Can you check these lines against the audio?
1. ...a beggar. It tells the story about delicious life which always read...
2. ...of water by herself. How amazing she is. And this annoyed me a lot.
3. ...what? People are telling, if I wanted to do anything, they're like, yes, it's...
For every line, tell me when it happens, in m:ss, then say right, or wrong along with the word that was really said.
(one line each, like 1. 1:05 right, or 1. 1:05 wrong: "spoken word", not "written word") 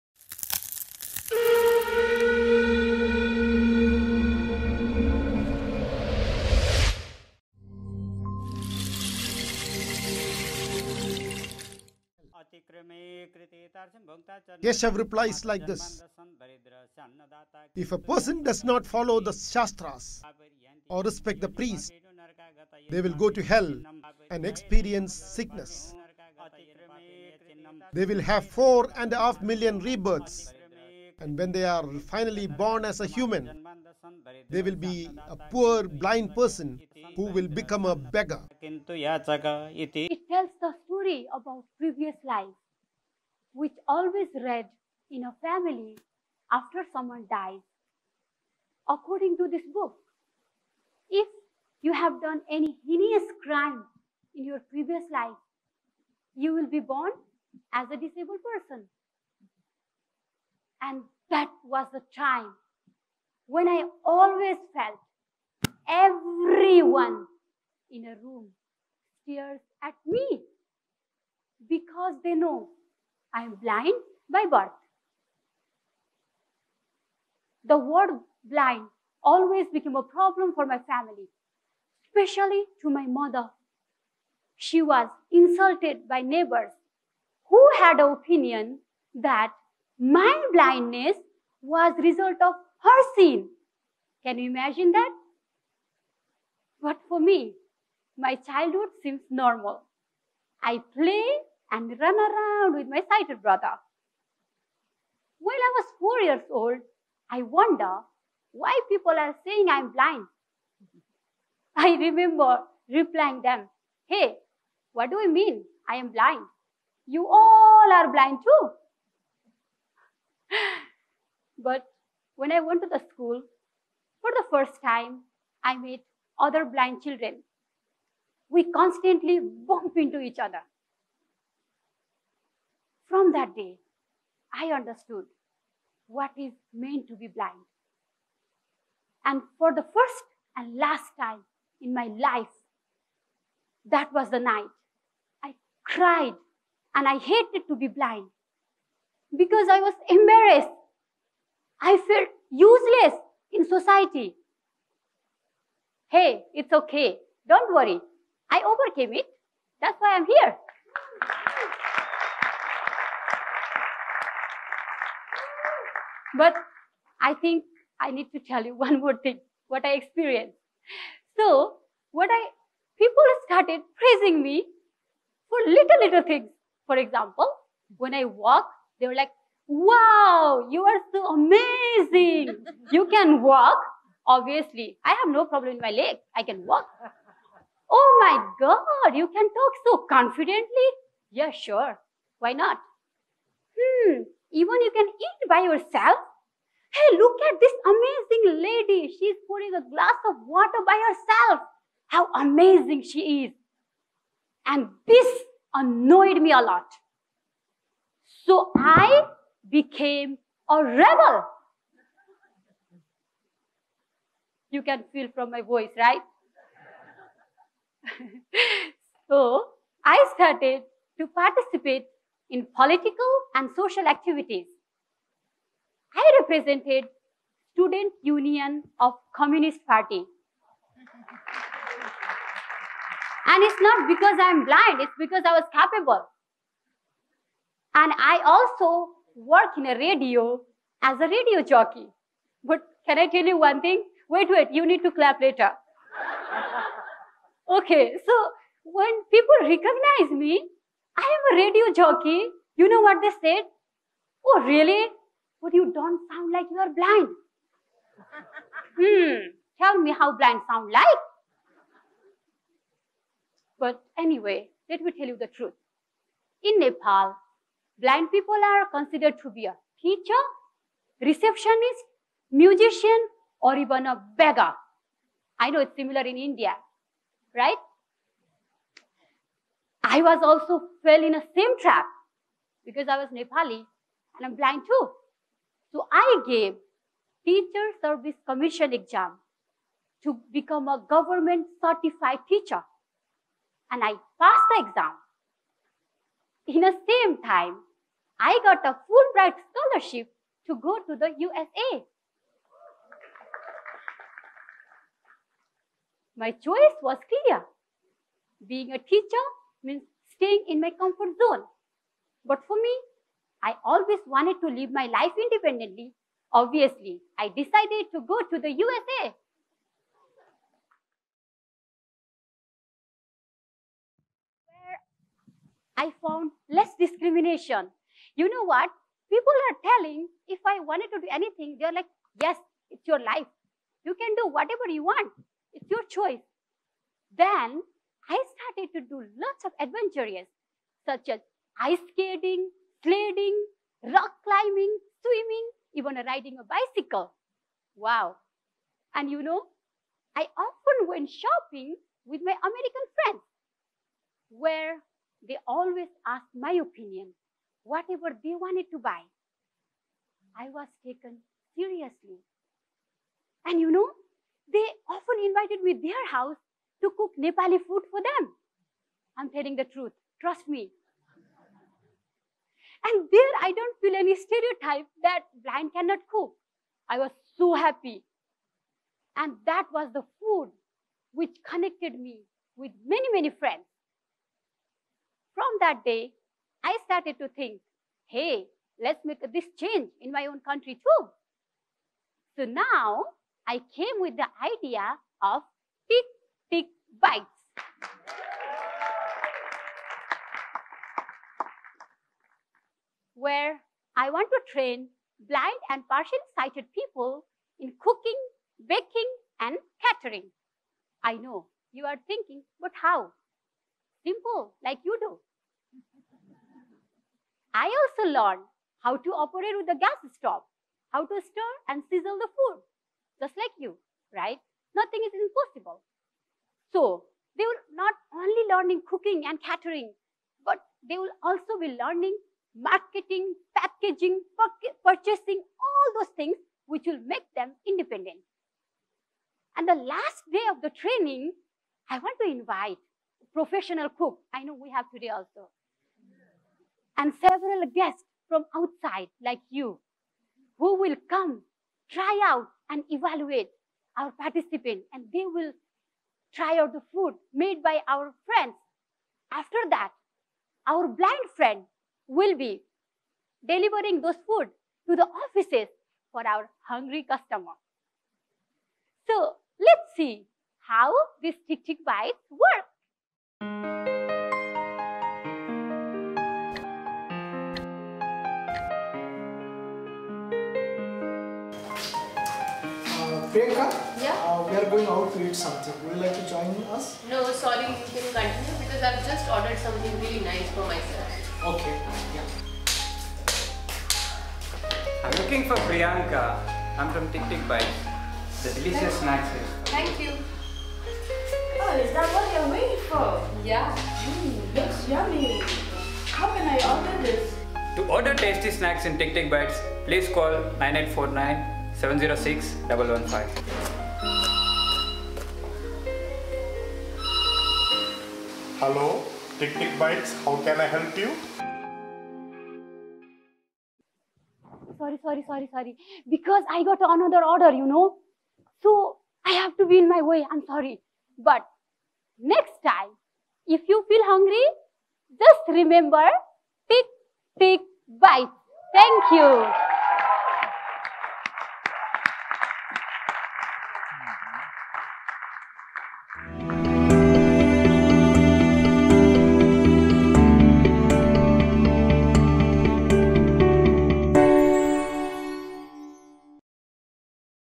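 1. 0:37 wrong: "previous", not "delicious"
2. 3:20 right
3. 5:28 right.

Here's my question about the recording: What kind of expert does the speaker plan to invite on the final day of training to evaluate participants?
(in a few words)
Professional cook.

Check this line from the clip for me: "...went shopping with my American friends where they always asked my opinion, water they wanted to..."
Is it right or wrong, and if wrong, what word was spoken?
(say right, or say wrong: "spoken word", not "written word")
wrong: "whatever", not "water".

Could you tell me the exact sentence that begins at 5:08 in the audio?
Being a teacher means staying in my comfort zone.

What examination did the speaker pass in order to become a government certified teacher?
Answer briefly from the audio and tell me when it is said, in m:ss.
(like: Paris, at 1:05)
Teacher service commission exam, at 4:47.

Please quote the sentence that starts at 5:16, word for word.
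Obviously, I decided to go to the USA.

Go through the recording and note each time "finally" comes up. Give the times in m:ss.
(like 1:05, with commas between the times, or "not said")
0:31.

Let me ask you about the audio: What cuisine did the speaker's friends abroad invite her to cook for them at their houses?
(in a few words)
Nepali food.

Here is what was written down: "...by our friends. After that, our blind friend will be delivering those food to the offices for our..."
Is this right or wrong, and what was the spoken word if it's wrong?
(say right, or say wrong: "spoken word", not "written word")
right.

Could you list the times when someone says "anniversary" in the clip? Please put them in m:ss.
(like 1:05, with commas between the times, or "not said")
not said.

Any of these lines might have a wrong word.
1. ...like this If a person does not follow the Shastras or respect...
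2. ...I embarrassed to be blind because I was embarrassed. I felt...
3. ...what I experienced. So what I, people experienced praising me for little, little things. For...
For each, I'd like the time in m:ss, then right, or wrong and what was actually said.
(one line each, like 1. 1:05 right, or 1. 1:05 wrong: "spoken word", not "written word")
1. 0:15 right
2. 2:27 wrong: "hated", not "embarrassed"
3. 2:49 wrong: "started", not "experienced".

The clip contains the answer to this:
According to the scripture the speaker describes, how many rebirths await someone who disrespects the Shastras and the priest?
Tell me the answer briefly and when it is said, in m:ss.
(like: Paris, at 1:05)
4.5 million, at 0:28.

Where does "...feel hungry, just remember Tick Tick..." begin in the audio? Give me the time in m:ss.
8:54.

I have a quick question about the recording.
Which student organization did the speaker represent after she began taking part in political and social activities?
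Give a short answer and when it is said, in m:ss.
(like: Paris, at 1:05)
Student Union of Communist Party, at 3:47.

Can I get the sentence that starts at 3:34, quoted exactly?
You can feel from my voice, right?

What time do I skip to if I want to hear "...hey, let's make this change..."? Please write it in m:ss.
6:28.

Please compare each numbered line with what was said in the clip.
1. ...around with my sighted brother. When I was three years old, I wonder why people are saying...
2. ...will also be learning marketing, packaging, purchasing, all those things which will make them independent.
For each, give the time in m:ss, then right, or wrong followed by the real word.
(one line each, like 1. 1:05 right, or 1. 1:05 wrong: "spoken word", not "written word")
1. 1:42 wrong: "four", not "three"
2. 7:11 right.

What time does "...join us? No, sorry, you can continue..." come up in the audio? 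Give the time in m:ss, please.
8:06.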